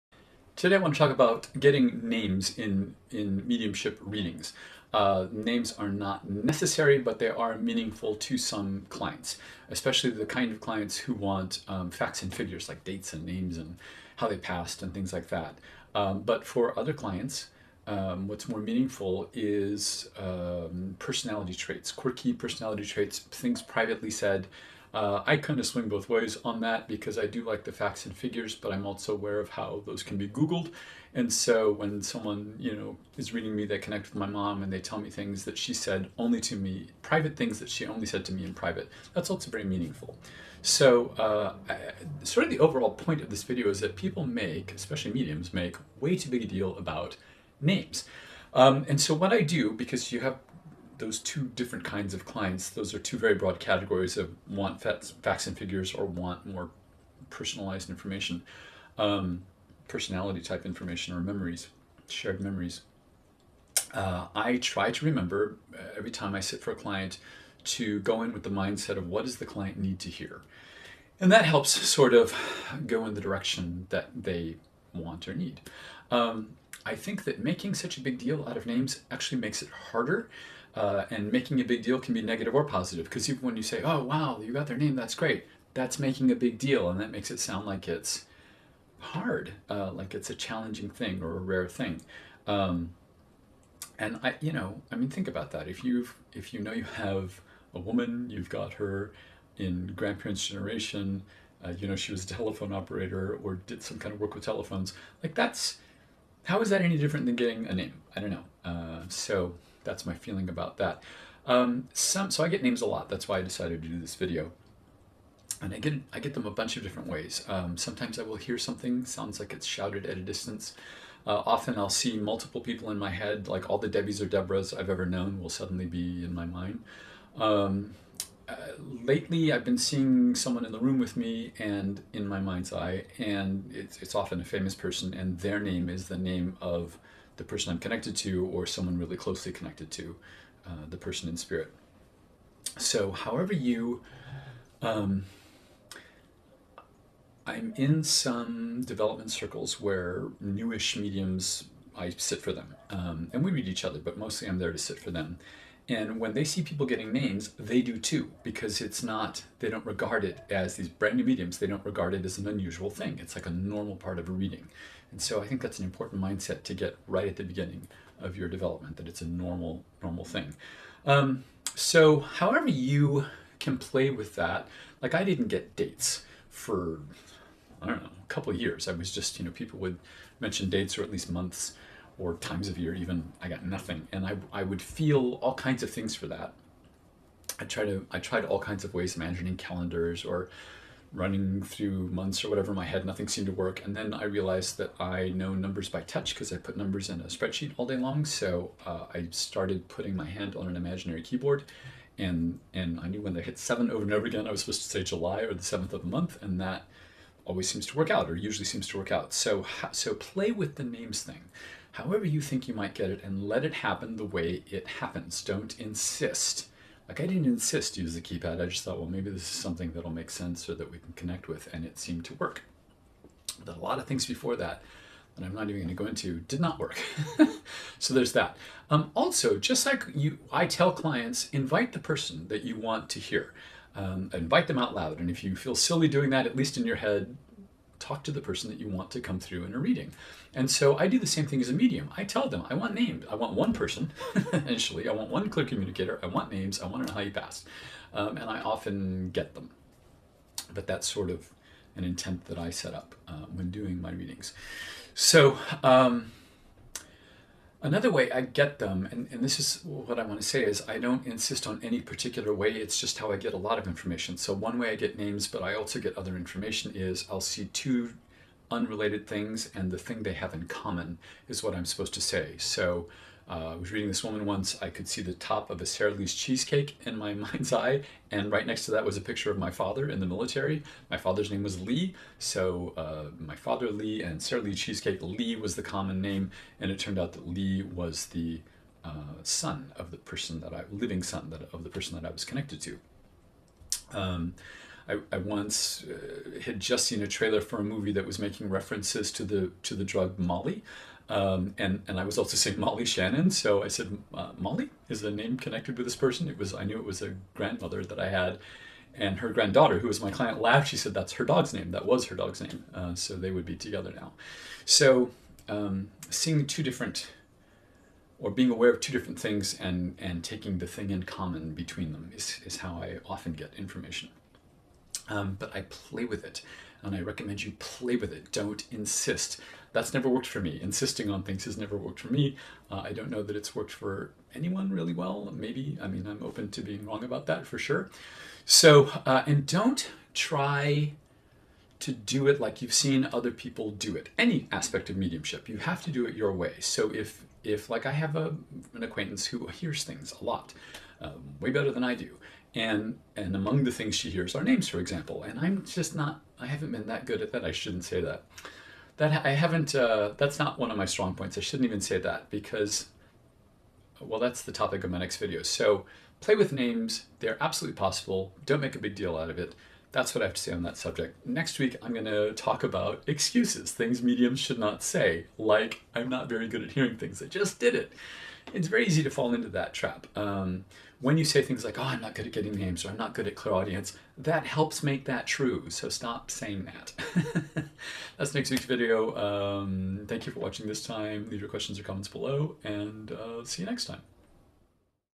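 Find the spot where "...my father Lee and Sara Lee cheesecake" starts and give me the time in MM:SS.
04:43.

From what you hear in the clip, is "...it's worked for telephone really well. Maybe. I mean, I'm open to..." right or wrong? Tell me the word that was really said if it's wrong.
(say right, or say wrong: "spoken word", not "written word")
wrong: "anyone", not "telephone".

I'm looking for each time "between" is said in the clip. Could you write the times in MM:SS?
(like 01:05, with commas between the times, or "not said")
05:21.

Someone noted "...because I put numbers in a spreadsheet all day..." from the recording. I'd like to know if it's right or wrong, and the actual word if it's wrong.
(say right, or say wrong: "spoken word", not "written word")
right.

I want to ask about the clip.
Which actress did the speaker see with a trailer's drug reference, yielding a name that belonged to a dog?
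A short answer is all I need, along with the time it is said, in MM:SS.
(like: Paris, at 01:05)
Molly Shannon, at 05:02.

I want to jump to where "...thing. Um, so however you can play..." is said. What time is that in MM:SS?
02:50.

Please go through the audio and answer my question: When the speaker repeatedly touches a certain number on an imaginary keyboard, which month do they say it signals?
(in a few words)
July.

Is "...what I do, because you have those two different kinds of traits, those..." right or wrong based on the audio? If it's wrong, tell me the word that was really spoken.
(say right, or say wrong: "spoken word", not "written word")
wrong: "clients", not "traits".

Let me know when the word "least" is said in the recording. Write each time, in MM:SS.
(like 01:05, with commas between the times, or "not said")
03:01, 03:56.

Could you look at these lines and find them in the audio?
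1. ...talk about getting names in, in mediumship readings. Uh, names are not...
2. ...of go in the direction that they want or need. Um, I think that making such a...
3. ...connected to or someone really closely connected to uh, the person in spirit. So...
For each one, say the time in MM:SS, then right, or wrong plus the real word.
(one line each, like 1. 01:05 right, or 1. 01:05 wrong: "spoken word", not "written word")
1. 00:00 right
2. 01:12 right
3. 02:17 right.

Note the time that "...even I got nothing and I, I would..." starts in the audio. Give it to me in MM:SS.
03:02.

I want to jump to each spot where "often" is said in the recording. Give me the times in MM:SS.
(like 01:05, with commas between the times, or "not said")
02:01, 02:14, 04:08, 05:23.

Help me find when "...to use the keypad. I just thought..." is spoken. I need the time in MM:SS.
03:37.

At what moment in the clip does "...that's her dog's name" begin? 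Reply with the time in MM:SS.
05:11.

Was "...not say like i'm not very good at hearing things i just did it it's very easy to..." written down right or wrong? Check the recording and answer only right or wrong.
right.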